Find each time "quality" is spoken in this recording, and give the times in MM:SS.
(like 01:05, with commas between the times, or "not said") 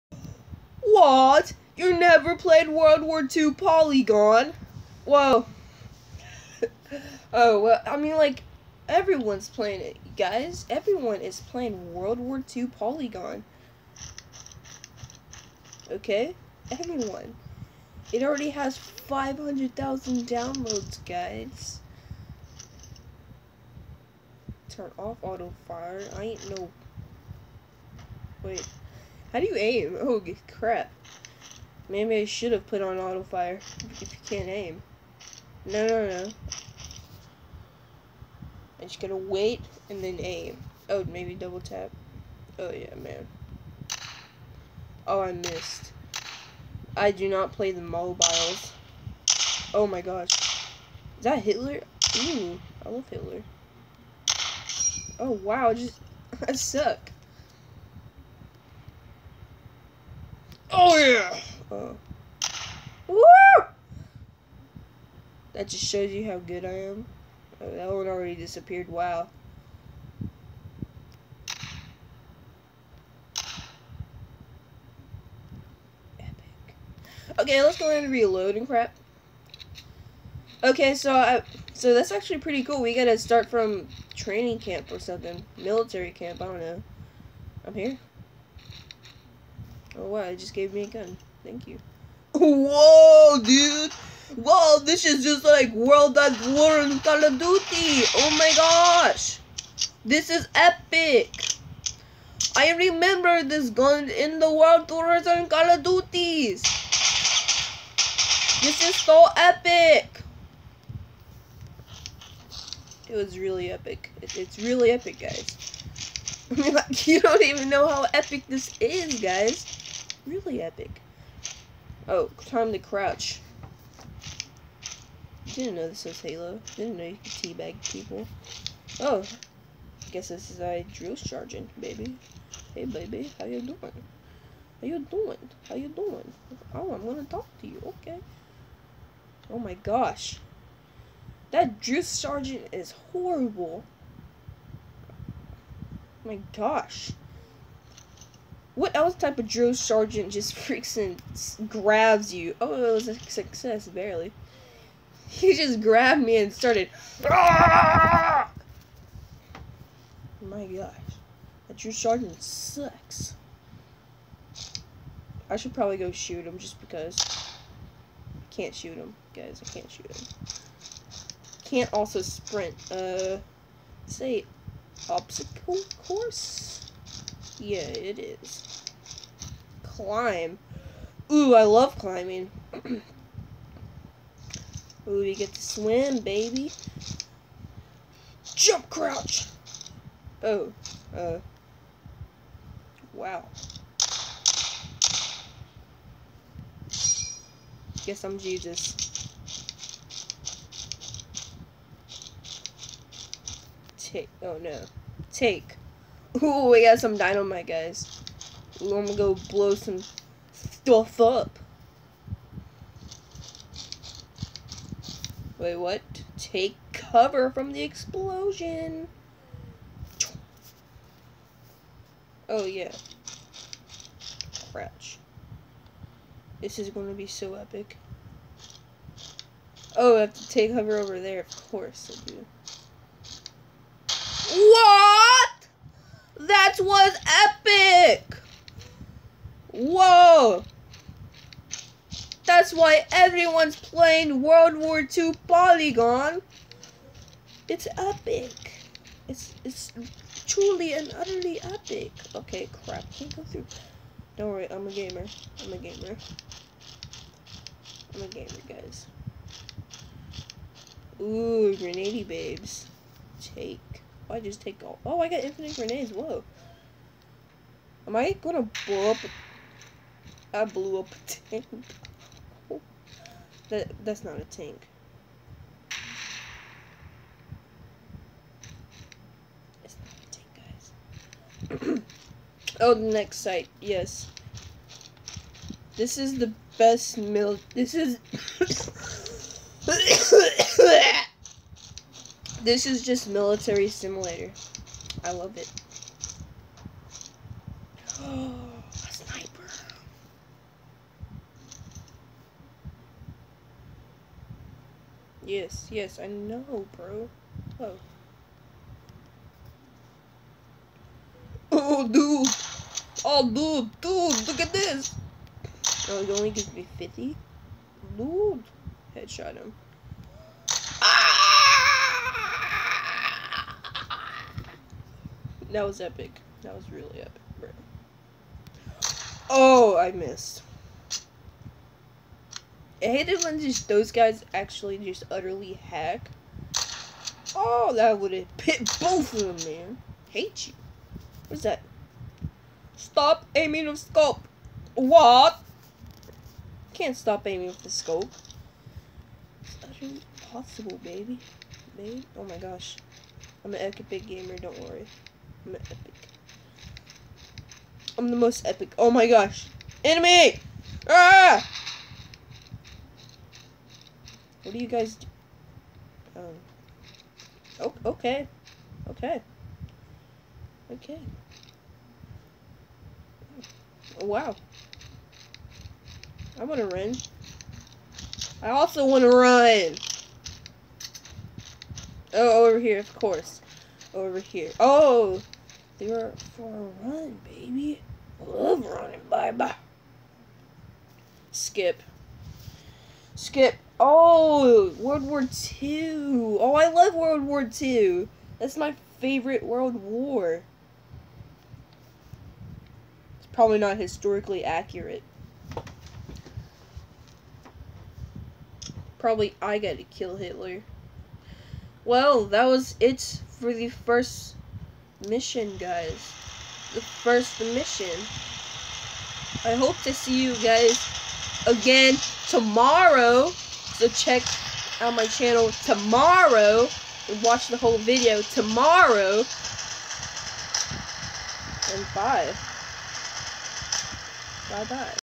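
not said.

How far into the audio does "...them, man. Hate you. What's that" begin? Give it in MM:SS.
05:39.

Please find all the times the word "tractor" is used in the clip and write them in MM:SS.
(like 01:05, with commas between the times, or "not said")
not said.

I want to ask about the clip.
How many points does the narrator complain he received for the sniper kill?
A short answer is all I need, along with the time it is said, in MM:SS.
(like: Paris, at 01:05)
50, at 05:16.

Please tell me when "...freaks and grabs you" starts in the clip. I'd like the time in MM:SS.
02:30.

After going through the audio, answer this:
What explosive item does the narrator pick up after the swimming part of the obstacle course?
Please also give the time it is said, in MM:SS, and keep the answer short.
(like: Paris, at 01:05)
dynamite, at 03:27.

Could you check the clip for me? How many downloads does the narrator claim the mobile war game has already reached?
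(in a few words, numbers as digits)
500,000.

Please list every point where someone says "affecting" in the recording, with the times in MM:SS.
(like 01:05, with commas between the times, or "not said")
not said.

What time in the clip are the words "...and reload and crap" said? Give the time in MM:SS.
01:18.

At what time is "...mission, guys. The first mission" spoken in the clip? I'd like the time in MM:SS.
06:55.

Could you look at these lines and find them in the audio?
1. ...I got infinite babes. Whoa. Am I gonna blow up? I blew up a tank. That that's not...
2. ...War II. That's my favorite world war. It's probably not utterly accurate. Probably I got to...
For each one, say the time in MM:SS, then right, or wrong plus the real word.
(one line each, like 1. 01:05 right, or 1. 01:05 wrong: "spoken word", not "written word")
1. 04:25 wrong: "grenades", not "babes"
2. 06:37 wrong: "historically", not "utterly".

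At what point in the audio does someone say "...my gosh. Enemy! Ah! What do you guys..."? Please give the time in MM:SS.
05:59.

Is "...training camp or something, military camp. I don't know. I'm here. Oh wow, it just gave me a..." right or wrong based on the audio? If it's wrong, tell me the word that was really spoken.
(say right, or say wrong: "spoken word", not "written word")
right.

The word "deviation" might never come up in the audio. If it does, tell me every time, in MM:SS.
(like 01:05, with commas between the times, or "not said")
not said.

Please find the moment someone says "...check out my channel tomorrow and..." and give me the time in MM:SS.
07:04.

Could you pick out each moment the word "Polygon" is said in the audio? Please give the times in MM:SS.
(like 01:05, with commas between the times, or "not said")
00:03, 00:12, 04:05.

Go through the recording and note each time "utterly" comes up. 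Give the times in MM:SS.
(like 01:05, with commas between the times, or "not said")
04:11, 05:35, 05:49.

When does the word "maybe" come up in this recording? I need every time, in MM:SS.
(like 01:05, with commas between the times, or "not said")
00:31, 00:41.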